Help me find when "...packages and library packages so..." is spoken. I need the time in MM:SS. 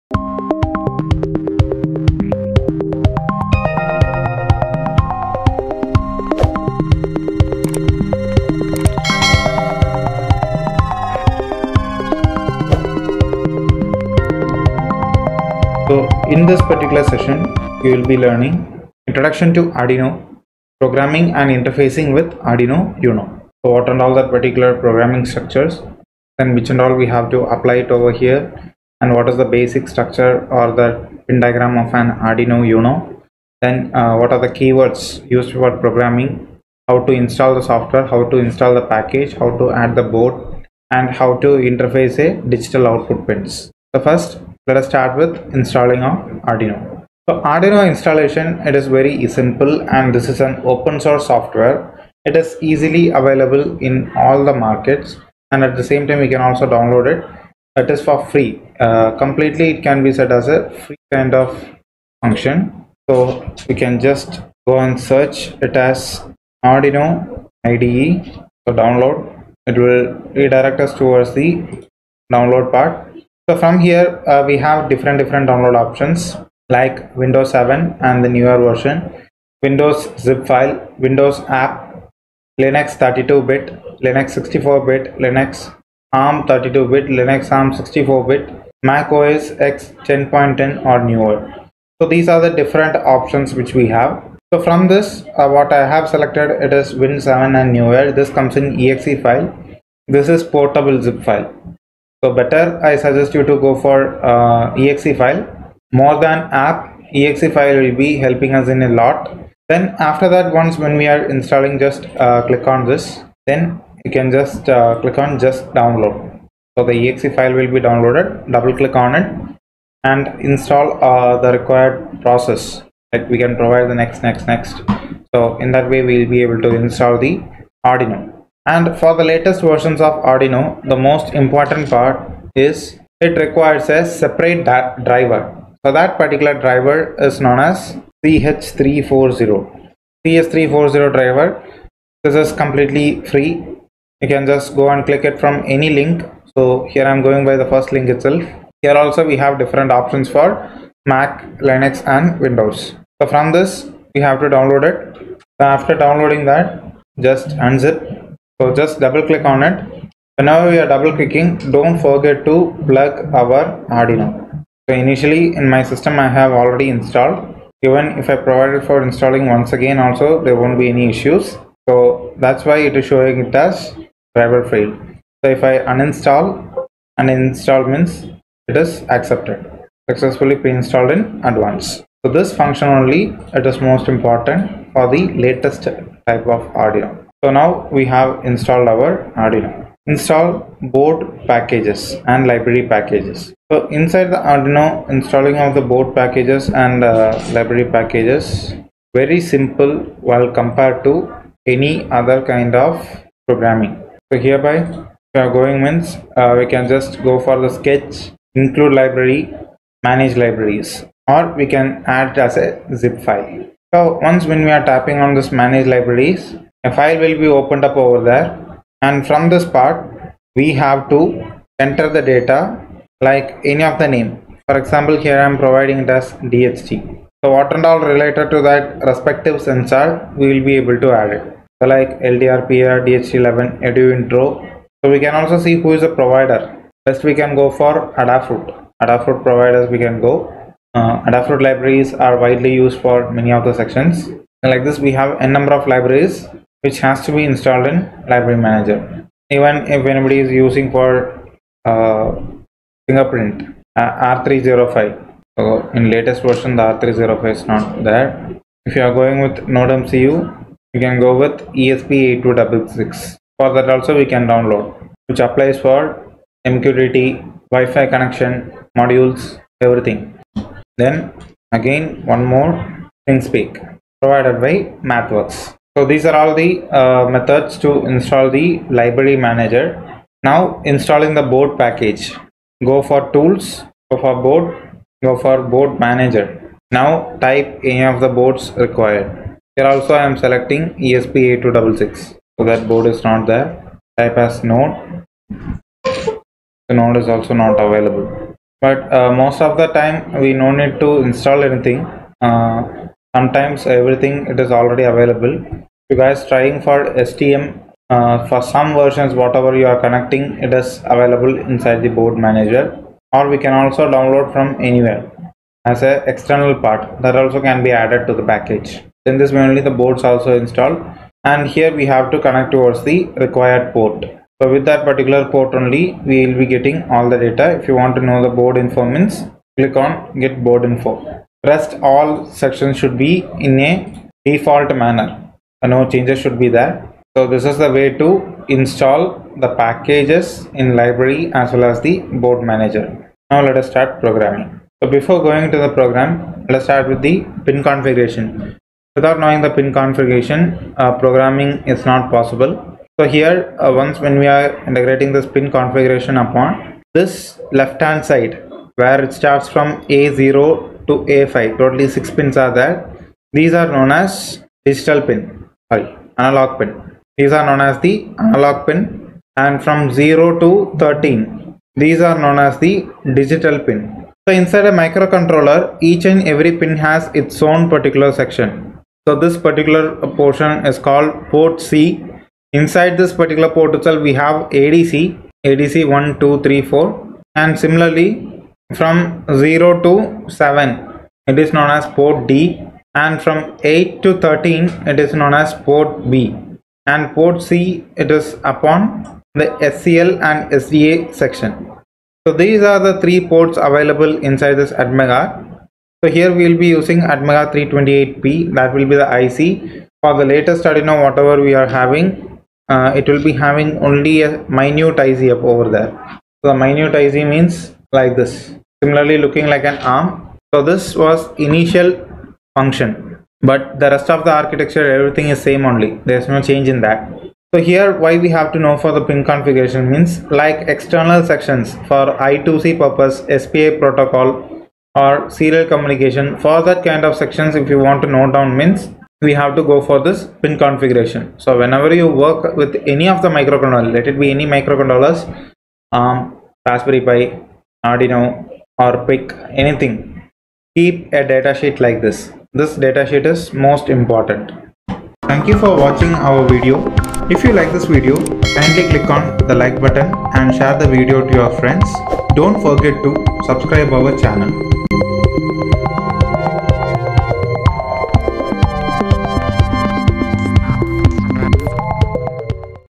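03:11.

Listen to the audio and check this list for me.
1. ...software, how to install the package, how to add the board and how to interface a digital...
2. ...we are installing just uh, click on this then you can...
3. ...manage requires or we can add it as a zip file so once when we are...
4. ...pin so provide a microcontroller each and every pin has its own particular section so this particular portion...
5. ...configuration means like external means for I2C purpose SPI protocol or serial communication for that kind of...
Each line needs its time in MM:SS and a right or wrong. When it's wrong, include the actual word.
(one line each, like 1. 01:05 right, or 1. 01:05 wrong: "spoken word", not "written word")
1. 00:37 right
2. 01:51 right
3. 03:30 wrong: "libraries", not "requires"
4. 06:13 wrong: "inside", not "provide"
5. 07:09 wrong: "sections", not "means".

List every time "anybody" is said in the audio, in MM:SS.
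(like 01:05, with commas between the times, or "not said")
04:10.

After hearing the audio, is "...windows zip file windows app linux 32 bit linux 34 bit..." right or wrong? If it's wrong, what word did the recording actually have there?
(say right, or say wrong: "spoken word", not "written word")
wrong: "64", not "34".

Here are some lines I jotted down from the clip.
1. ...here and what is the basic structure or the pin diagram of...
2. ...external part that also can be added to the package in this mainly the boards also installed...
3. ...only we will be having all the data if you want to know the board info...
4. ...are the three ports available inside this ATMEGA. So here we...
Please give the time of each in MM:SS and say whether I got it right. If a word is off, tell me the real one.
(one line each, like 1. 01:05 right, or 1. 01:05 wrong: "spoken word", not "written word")
1. 00:28 right
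2. 05:16 right
3. 05:25 wrong: "getting", not "having"
4. 06:42 right.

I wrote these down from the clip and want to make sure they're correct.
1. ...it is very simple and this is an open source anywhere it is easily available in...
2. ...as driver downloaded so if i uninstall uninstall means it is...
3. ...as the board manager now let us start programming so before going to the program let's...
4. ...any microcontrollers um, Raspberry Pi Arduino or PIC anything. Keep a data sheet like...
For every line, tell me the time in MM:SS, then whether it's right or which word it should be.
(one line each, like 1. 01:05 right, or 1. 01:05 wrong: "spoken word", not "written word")
1. 00:48 wrong: "software", not "anywhere"
2. 02:53 wrong: "failed", not "downloaded"
3. 05:41 right
4. 07:24 right.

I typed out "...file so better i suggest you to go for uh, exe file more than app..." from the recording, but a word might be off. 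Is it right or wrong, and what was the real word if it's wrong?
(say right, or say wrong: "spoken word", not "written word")
right.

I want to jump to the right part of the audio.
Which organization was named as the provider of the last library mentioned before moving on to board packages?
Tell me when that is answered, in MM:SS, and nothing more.
04:35.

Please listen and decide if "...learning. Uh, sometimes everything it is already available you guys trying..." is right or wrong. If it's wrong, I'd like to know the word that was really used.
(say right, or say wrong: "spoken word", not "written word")
wrong: "anything", not "learning".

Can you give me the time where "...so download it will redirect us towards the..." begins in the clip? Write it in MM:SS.
01:08.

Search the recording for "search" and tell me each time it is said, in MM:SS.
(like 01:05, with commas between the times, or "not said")
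01:05.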